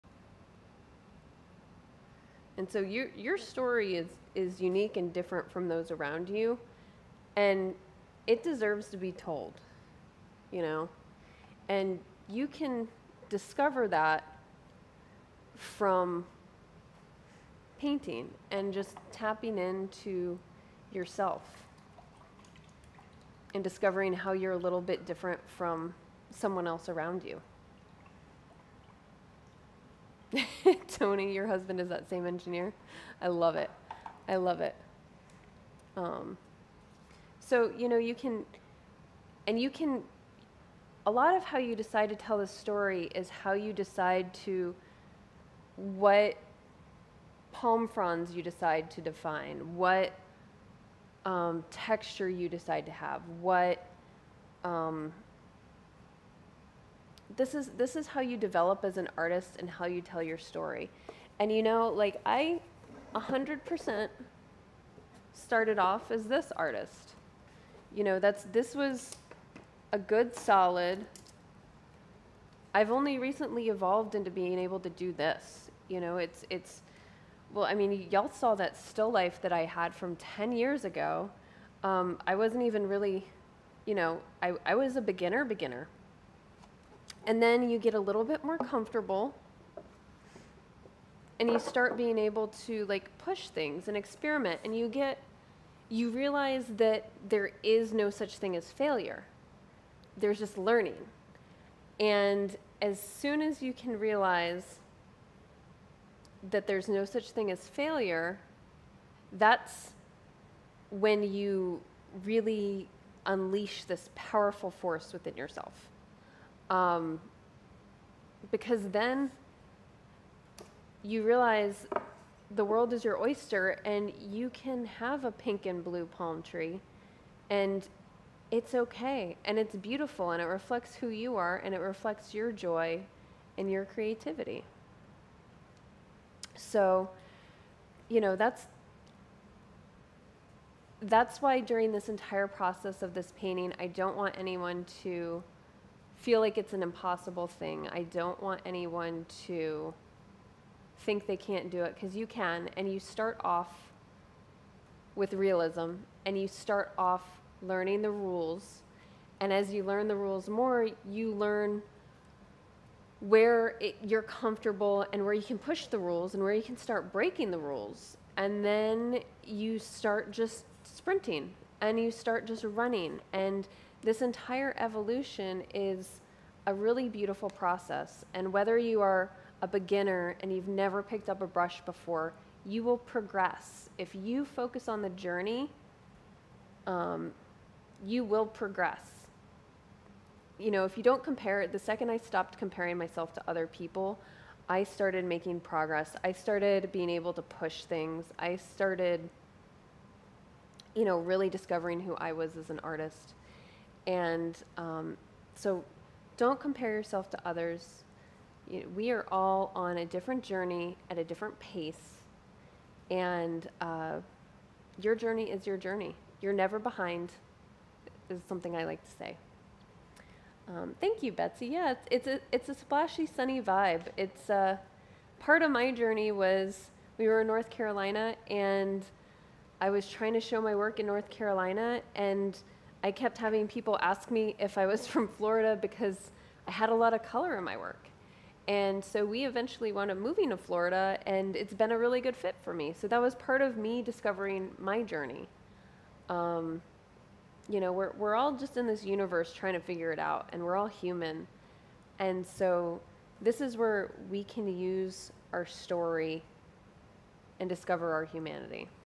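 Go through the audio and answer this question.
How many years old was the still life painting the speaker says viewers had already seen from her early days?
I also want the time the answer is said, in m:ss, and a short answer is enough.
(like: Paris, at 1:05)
10, at 1:20.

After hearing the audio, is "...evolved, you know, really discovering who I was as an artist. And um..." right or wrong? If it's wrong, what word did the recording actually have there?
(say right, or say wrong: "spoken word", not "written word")
wrong: "started", not "evolved".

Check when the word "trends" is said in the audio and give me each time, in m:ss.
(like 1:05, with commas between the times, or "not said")
not said.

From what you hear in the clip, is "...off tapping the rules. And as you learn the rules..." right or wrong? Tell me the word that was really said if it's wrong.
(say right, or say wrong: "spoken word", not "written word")
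wrong: "learning", not "tapping".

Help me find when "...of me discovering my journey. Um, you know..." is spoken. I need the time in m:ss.
4:03.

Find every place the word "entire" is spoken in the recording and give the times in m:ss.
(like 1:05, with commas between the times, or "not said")
2:22, 2:54.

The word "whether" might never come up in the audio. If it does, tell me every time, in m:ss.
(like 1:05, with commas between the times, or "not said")
2:58.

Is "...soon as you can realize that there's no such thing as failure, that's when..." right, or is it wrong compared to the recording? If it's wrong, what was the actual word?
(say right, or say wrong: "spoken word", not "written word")
right.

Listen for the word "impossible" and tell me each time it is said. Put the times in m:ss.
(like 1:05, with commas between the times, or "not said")
2:26.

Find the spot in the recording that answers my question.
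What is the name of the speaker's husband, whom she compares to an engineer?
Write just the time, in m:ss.
0:31.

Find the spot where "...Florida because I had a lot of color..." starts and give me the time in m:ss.
3:55.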